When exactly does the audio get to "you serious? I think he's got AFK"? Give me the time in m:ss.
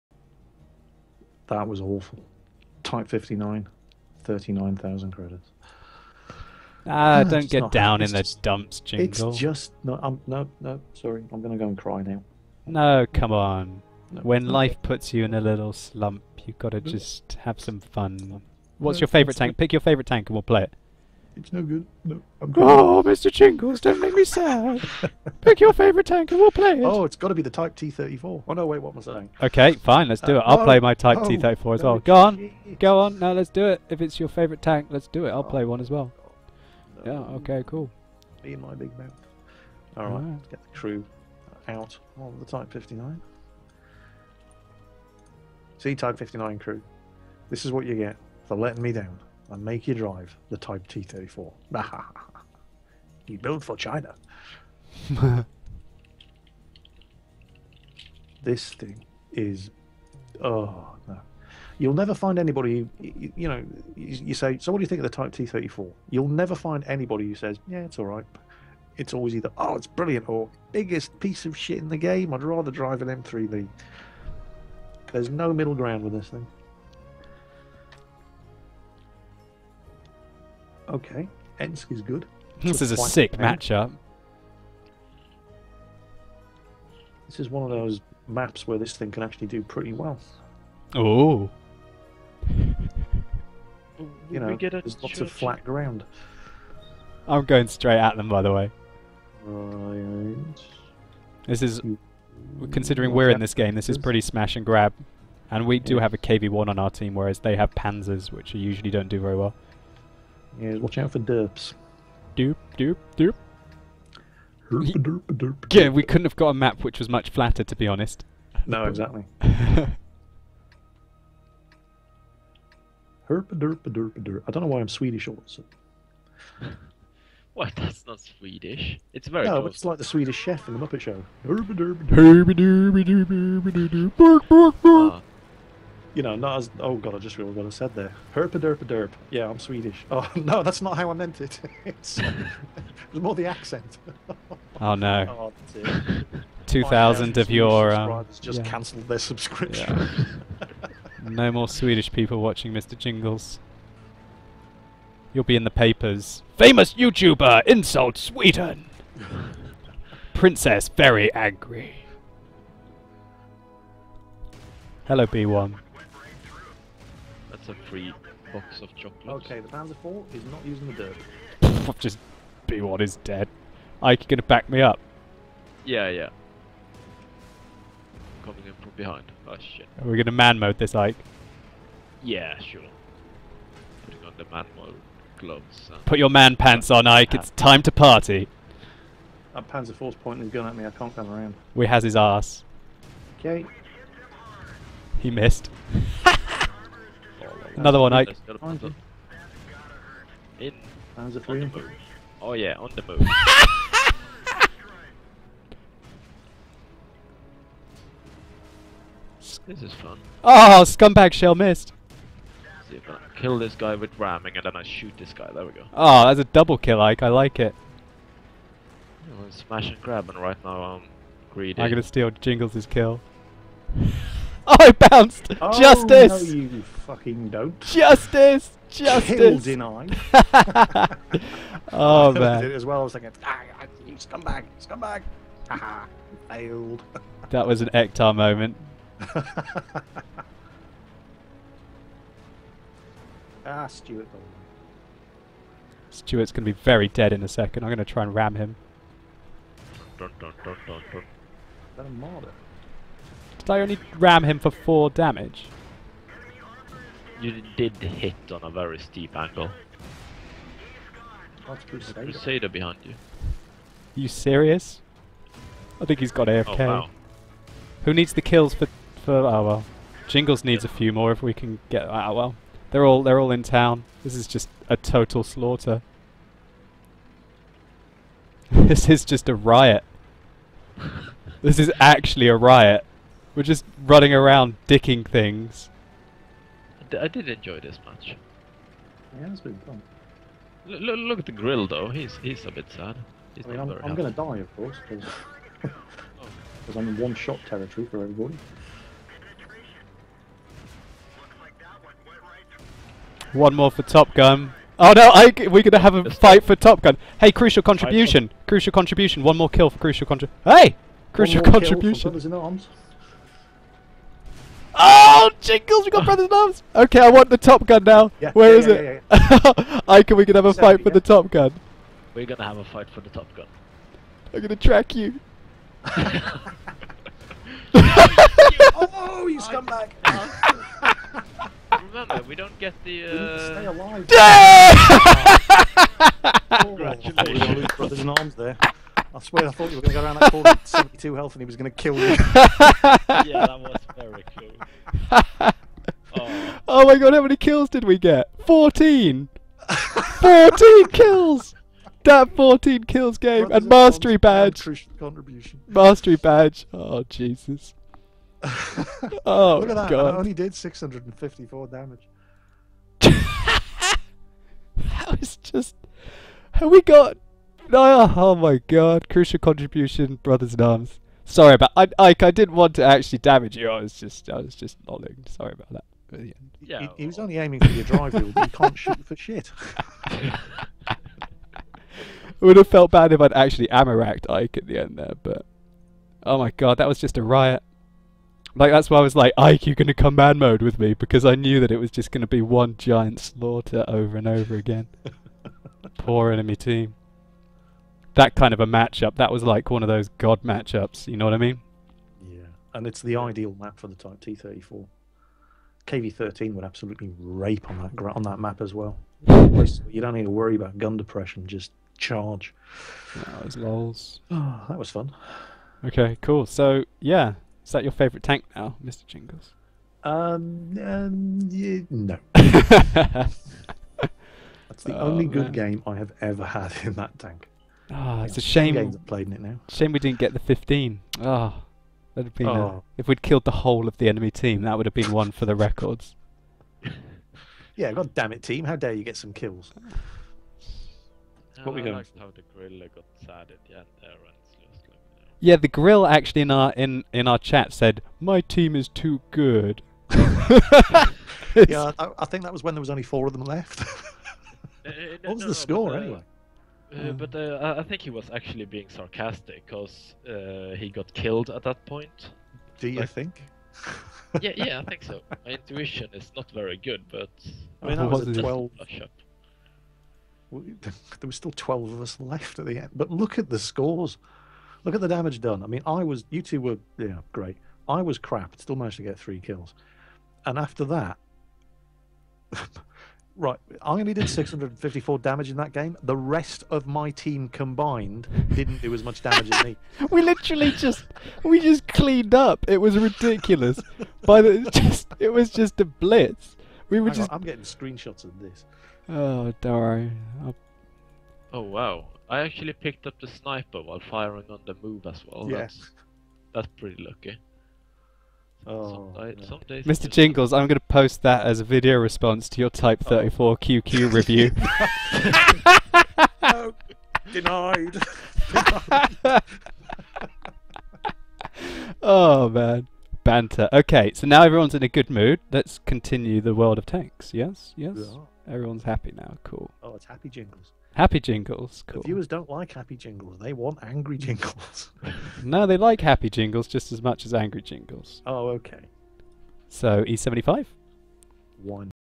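4:24.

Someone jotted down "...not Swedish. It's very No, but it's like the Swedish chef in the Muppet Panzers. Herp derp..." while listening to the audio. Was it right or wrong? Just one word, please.
wrong.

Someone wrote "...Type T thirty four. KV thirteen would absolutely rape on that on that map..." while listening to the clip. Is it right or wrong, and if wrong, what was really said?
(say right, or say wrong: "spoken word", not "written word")
right.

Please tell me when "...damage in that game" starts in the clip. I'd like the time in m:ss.
8:05.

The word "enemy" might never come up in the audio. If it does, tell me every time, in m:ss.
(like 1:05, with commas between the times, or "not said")
6:36, 7:14.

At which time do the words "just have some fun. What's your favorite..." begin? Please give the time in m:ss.
0:16.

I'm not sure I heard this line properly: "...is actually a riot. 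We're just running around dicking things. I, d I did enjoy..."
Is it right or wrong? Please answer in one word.
right.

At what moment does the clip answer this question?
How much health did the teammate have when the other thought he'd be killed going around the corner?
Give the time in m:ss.
5:40.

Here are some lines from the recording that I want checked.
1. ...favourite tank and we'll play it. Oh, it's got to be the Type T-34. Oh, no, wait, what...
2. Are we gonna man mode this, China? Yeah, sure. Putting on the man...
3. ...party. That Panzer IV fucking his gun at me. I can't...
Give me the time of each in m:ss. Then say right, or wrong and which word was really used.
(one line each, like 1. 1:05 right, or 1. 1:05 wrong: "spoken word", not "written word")
1. 0:25 right
2. 3:00 wrong: "Ike", not "China"
3. 3:07 wrong: "pointing", not "fucking".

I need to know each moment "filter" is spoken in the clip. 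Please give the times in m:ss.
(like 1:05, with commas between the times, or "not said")
not said.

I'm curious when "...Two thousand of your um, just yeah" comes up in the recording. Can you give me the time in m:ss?
2:26.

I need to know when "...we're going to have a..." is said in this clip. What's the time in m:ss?
5:05.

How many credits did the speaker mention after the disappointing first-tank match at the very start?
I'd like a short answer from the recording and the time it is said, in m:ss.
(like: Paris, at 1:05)
39,000, at 0:04.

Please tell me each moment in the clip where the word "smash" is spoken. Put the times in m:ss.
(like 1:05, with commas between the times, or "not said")
1:44, 3:39.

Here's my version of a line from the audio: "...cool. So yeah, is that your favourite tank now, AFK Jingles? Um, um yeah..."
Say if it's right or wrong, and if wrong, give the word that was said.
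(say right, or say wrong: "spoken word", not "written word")
wrong: "Mister", not "AFK".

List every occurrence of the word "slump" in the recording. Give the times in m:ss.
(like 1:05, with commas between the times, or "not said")
0:15.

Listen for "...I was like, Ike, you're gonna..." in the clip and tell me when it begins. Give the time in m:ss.
6:29.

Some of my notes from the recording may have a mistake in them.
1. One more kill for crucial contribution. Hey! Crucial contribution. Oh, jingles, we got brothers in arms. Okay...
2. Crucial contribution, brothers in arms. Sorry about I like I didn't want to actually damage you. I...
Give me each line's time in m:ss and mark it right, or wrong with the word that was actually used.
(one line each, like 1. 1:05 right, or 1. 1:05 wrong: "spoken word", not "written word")
1. 5:09 right
2. 6:09 right.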